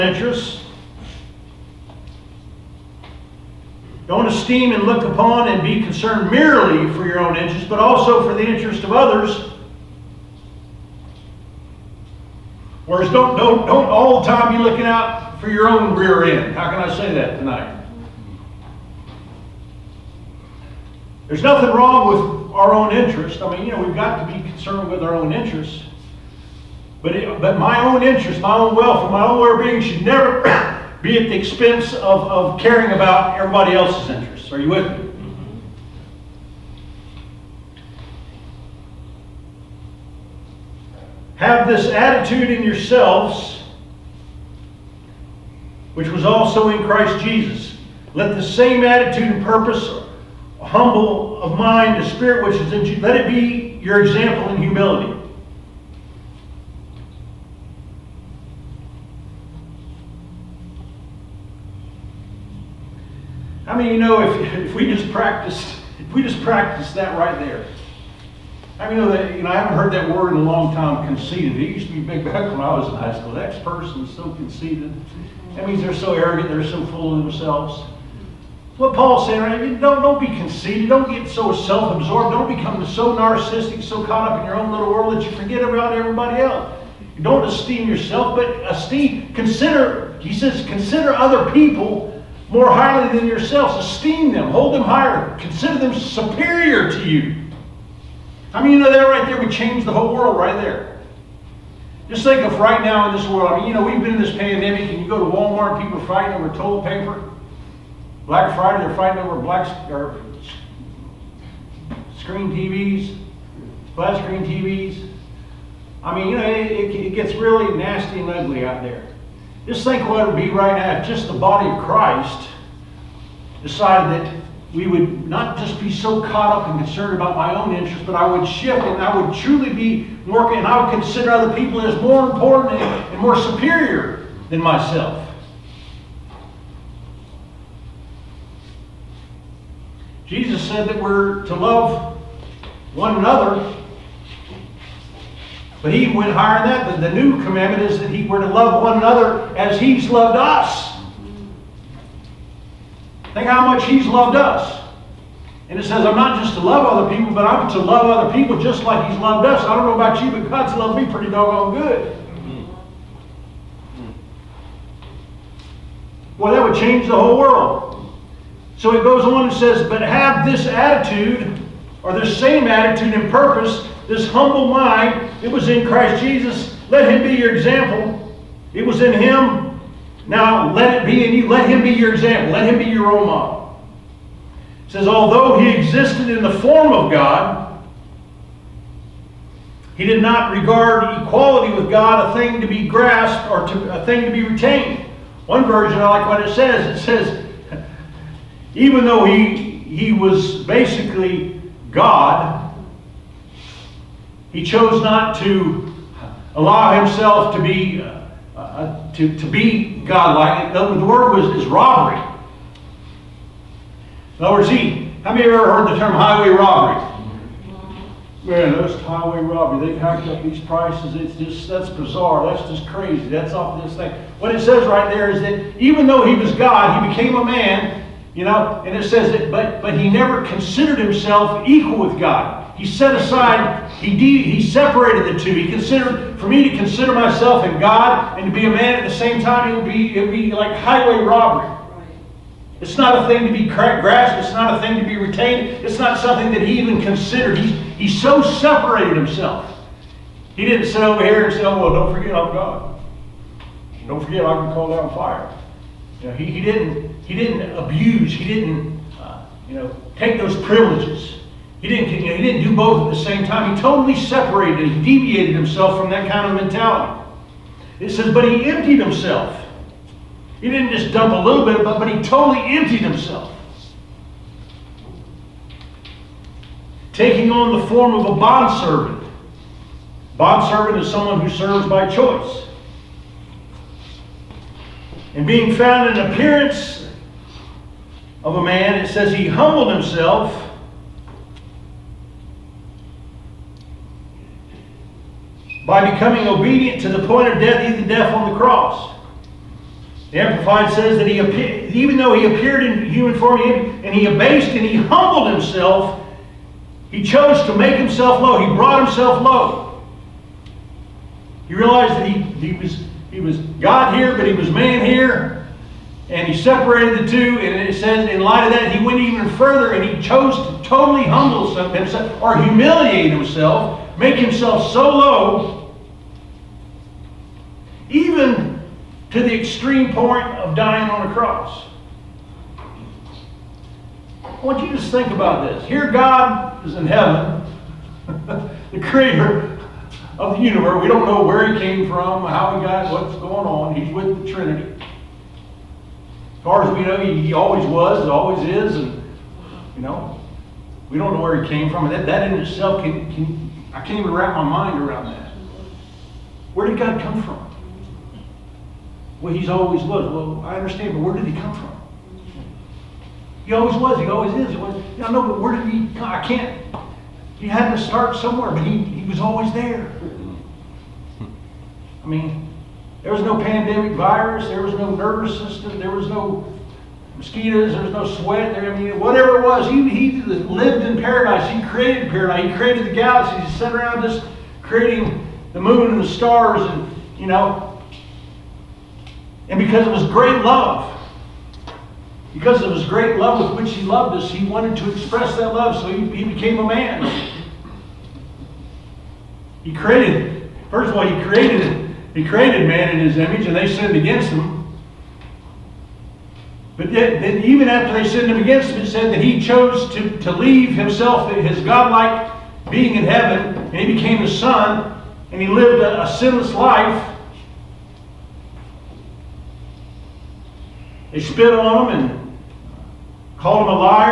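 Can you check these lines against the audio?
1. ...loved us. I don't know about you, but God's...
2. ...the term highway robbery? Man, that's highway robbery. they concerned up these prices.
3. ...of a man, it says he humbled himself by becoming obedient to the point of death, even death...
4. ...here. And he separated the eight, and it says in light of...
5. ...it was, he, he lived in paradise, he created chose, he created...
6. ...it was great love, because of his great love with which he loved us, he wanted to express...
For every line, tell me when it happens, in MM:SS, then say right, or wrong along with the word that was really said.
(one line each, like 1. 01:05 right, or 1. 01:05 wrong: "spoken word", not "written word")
1. 02:39 right
2. 03:35 wrong: "hacked", not "concerned"
3. 04:48 right
4. 05:15 wrong: "two", not "eight"
5. 06:19 wrong: "paradise", not "chose"
6. 06:30 right.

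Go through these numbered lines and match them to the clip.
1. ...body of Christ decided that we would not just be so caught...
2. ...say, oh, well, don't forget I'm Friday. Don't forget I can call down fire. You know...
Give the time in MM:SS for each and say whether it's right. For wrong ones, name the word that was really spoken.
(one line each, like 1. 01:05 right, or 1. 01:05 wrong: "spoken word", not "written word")
1. 02:01 right
2. 04:11 wrong: "God", not "Friday".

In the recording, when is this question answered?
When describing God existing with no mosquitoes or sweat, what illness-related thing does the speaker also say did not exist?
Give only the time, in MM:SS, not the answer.
06:13.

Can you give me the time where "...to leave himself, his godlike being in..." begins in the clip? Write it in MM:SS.
06:50.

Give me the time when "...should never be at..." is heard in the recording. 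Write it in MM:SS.
00:29.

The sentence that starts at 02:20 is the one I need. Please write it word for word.
Jesus said that we're to love one another but he went higher than that.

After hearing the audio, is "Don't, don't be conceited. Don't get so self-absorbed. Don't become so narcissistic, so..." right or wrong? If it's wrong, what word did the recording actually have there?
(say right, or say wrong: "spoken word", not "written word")
right.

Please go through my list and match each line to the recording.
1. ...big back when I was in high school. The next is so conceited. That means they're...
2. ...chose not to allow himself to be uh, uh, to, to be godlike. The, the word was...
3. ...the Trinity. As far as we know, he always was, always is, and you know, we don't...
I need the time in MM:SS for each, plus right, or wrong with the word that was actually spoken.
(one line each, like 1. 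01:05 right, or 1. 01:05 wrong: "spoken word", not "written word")
1. 01:12 right
2. 03:24 right
3. 05:44 right.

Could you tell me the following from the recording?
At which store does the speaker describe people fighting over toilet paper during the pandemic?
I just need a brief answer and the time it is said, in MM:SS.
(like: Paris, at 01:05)
Walmart, at 01:45.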